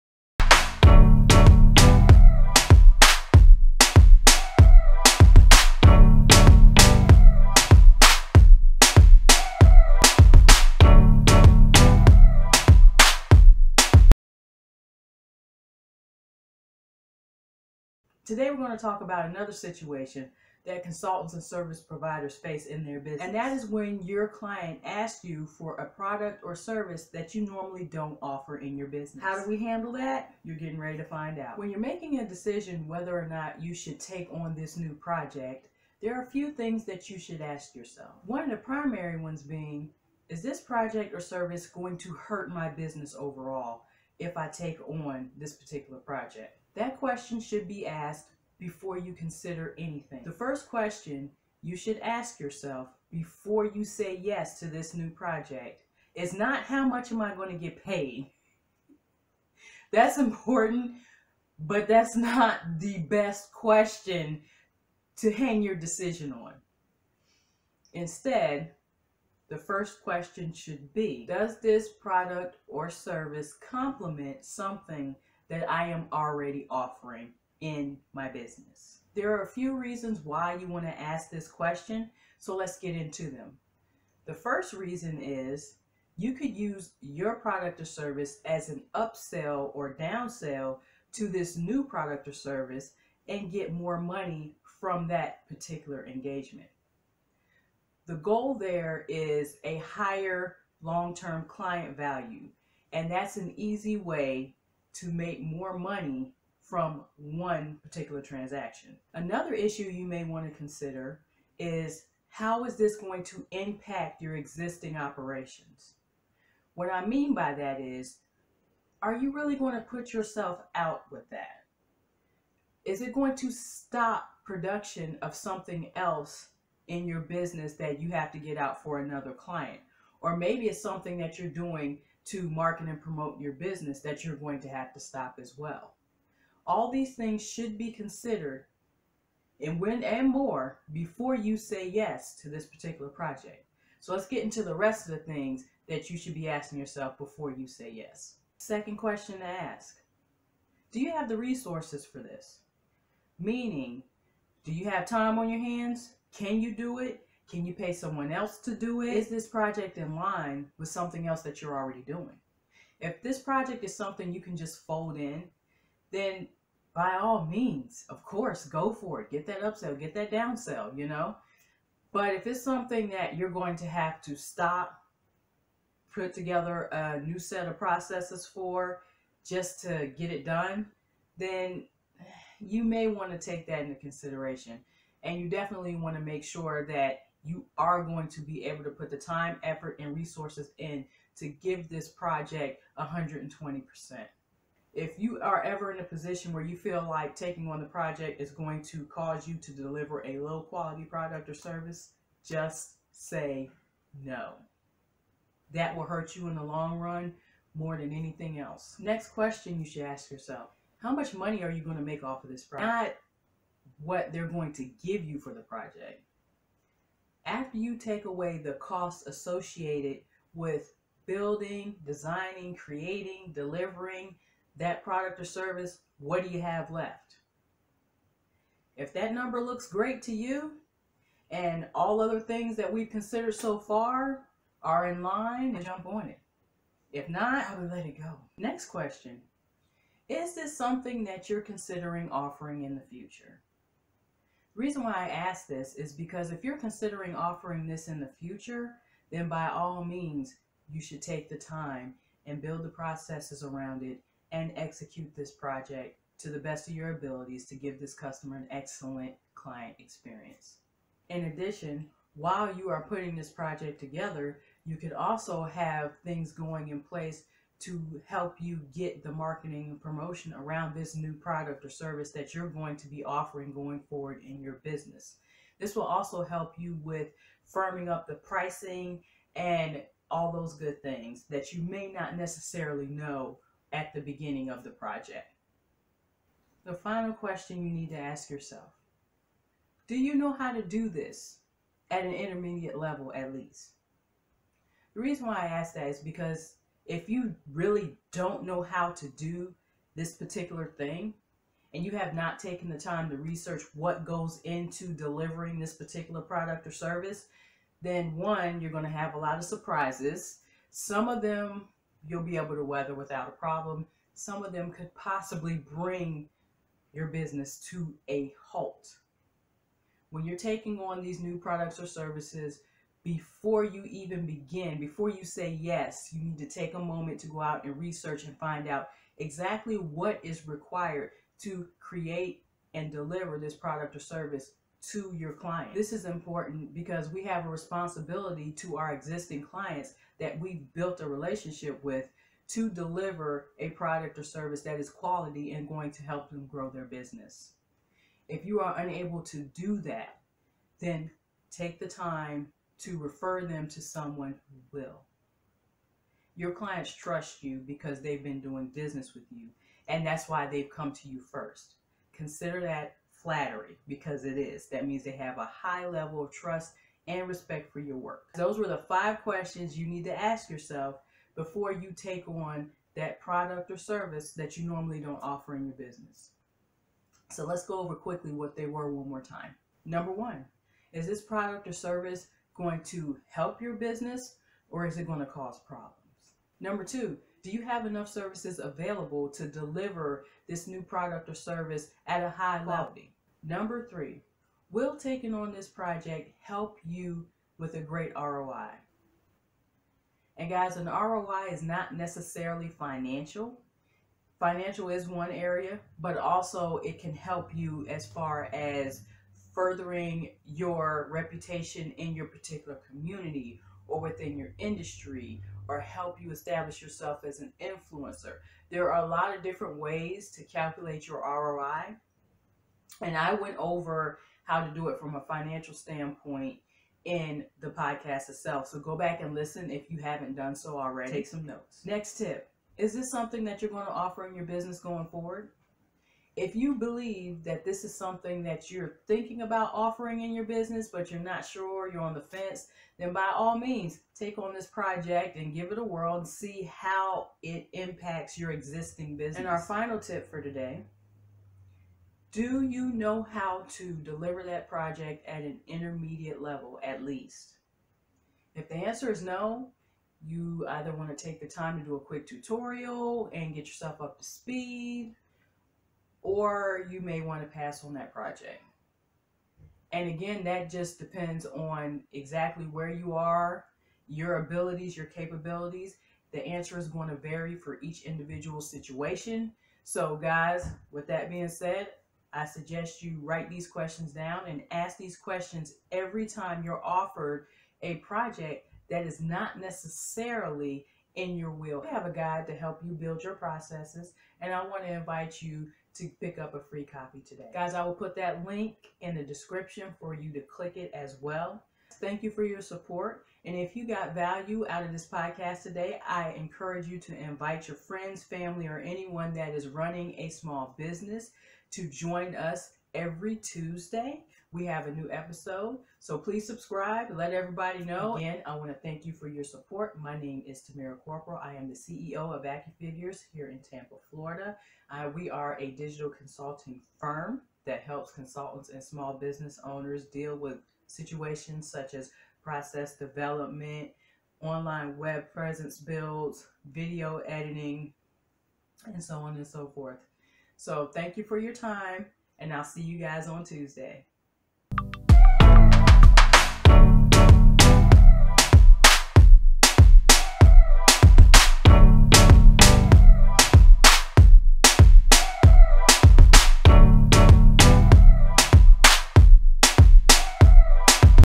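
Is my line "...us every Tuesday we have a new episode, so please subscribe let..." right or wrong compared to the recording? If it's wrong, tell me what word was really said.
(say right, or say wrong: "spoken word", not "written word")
right.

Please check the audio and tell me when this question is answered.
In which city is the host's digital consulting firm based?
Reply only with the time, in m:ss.
8:43.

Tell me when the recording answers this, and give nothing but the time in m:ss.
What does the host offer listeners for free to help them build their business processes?
8:12.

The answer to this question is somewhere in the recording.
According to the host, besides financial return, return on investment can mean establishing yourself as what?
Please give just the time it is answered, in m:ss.
6:57.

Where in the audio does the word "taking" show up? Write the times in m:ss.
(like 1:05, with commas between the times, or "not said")
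3:17, 5:20, 6:35.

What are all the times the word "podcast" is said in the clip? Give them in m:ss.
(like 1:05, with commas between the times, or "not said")
7:07, 8:25.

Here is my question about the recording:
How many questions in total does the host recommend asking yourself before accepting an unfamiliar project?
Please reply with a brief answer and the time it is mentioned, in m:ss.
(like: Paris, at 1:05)
5, at 6:09.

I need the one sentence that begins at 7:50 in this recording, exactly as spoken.
And again, that just depends on exactly where you are, your abilities, your capabilities.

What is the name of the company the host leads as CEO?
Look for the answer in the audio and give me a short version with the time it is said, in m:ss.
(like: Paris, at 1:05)
AccuFigures, at 8:42.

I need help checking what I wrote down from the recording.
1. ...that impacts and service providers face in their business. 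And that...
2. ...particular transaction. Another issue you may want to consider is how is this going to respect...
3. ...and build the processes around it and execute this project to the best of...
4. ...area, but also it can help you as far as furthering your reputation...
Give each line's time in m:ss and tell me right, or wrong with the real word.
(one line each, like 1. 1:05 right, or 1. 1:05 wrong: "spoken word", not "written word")
1. 0:20 wrong: "consultants", not "impacts"
2. 1:47 wrong: "impact", not "respect"
3. 4:12 right
4. 6:45 right.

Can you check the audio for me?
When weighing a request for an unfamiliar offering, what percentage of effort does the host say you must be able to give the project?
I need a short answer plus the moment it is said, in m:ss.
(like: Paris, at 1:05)
120%, at 3:12.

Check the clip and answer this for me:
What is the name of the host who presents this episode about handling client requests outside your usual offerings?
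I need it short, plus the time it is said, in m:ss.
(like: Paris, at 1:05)
Tamara Corporal, at 8:40.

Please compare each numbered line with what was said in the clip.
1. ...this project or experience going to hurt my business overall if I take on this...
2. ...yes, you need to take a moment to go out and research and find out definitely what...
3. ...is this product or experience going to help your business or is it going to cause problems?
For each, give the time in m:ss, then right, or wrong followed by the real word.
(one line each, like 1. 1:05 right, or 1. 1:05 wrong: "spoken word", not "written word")
1. 0:40 wrong: "service", not "experience"
2. 5:25 wrong: "exactly", not "definitely"
3. 6:21 wrong: "service", not "experience".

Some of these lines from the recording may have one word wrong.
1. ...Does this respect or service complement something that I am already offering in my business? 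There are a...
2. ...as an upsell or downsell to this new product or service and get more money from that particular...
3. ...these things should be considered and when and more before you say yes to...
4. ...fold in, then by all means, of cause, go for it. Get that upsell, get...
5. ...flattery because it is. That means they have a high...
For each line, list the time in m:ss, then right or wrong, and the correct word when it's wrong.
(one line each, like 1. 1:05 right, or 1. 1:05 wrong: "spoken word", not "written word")
1. 1:11 wrong: "product", not "respect"
2. 1:28 right
3. 2:16 right
4. 2:44 wrong: "course", not "cause"
5. 6:03 right.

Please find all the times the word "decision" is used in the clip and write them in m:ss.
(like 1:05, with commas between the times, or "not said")
0:32, 1:05.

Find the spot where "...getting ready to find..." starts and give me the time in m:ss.
0:30.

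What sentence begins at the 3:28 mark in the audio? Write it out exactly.
Next question you should ask yourself how much money are you going to make off of this project?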